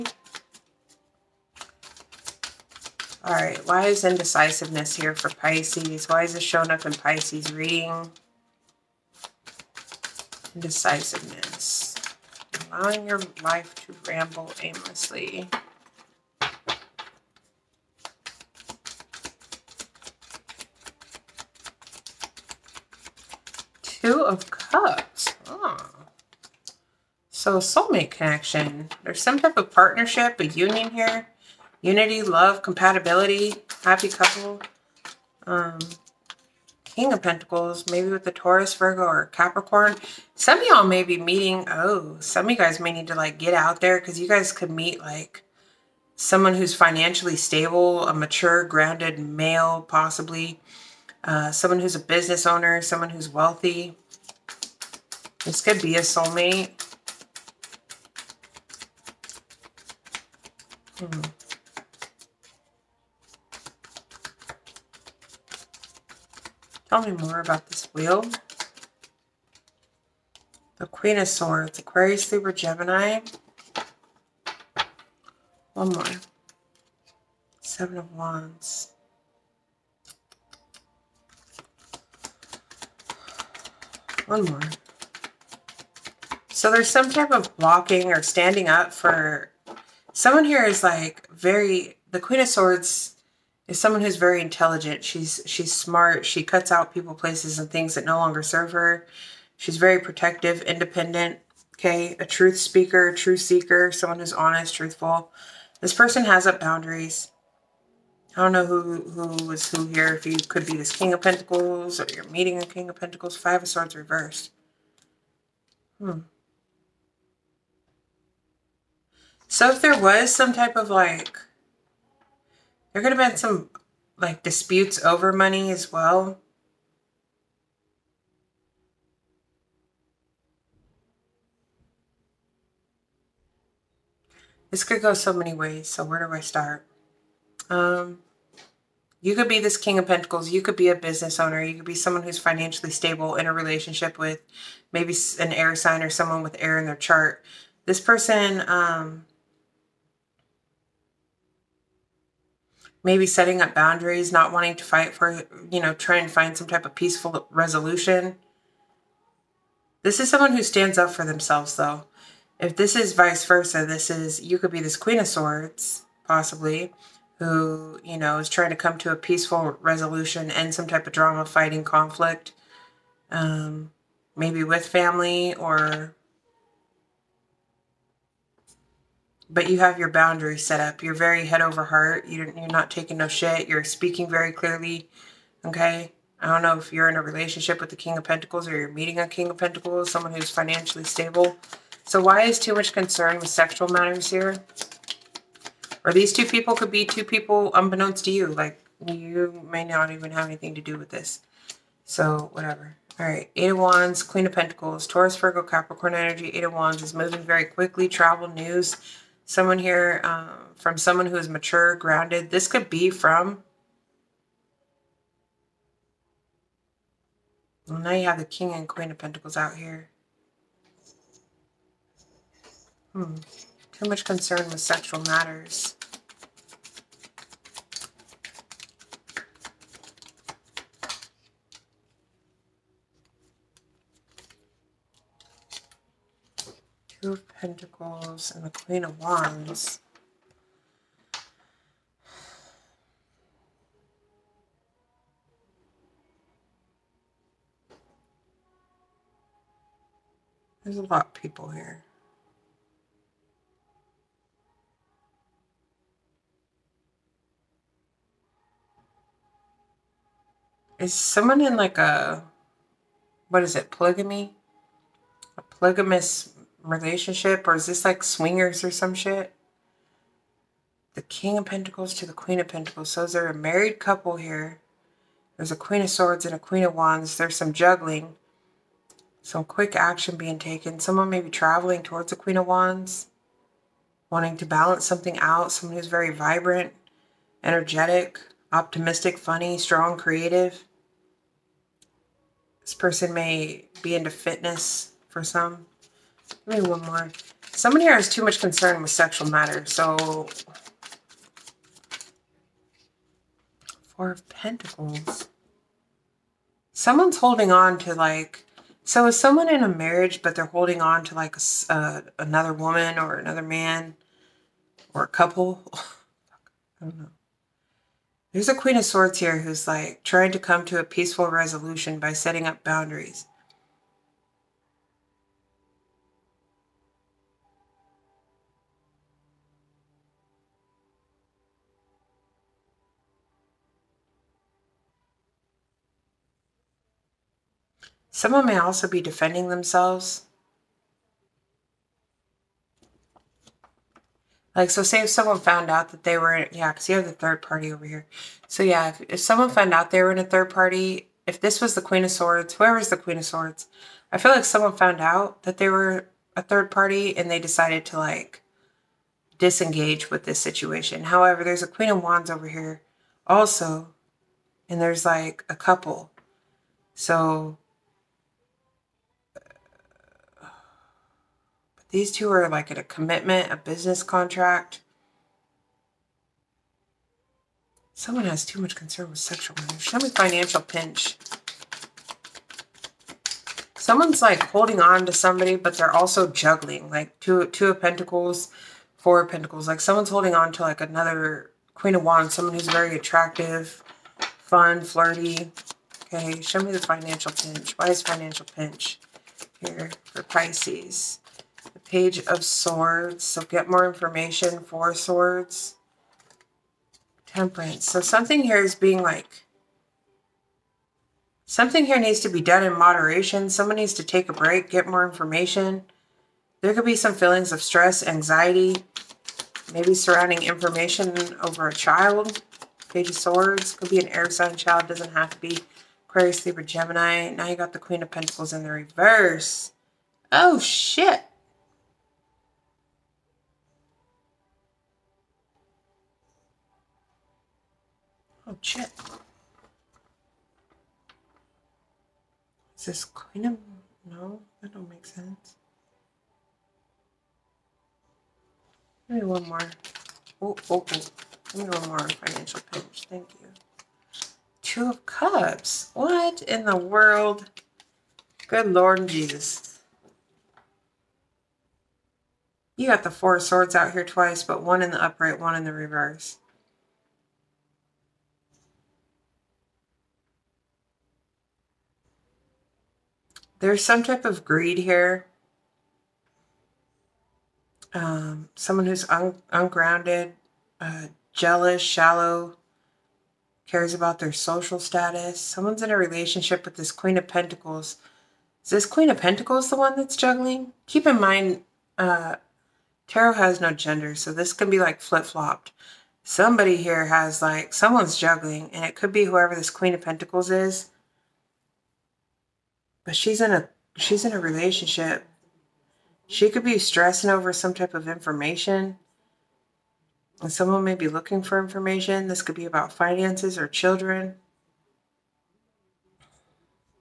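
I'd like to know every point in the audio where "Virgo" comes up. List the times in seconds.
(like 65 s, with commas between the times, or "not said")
38 s, 205 s.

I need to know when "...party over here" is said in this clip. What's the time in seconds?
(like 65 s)
347 s.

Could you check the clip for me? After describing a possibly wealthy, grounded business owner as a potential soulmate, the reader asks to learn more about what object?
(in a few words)
This wheel.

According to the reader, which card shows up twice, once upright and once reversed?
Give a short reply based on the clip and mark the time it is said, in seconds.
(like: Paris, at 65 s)
Four of Swords, at 463 s.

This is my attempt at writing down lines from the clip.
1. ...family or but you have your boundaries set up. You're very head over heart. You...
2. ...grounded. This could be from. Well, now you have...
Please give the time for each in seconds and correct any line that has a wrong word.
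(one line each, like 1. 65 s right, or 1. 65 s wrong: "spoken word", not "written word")
1. 174 s right
2. 211 s right.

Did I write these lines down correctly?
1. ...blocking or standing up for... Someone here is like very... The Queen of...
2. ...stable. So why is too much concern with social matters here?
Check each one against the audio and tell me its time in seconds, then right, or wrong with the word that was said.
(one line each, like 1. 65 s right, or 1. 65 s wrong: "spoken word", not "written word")
1. 87 s right
2. 191 s wrong: "sexual", not "social".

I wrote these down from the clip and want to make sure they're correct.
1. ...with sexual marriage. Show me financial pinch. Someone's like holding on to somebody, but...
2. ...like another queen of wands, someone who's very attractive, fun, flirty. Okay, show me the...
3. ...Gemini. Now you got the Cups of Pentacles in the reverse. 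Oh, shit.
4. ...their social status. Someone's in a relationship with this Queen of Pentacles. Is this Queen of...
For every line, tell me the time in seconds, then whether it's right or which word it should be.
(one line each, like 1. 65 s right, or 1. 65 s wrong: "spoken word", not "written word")
1. 379 s right
2. 390 s right
3. 426 s wrong: "Queen", not "Cups"
4. 484 s right.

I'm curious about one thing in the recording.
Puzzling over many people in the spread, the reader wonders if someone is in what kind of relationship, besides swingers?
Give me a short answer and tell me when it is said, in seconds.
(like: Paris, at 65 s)
Polygamous, at 265 s.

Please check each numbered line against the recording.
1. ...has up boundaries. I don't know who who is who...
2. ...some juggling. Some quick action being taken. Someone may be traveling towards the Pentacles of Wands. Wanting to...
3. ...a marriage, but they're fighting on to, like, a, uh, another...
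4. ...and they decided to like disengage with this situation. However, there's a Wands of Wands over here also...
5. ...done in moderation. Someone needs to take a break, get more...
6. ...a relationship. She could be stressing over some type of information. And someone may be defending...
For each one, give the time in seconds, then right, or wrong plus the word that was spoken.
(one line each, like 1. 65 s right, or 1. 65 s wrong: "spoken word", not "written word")
1. 106 s right
2. 277 s wrong: "Queen", not "Pentacles"
3. 309 s wrong: "holding", not "fighting"
4. 357 s wrong: "Queen", not "Wands"
5. 412 s right
6. 504 s wrong: "looking", not "defending".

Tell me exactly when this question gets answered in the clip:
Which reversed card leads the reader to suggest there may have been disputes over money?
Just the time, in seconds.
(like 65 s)
113 s.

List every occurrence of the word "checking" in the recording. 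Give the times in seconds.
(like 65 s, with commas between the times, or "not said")
not said.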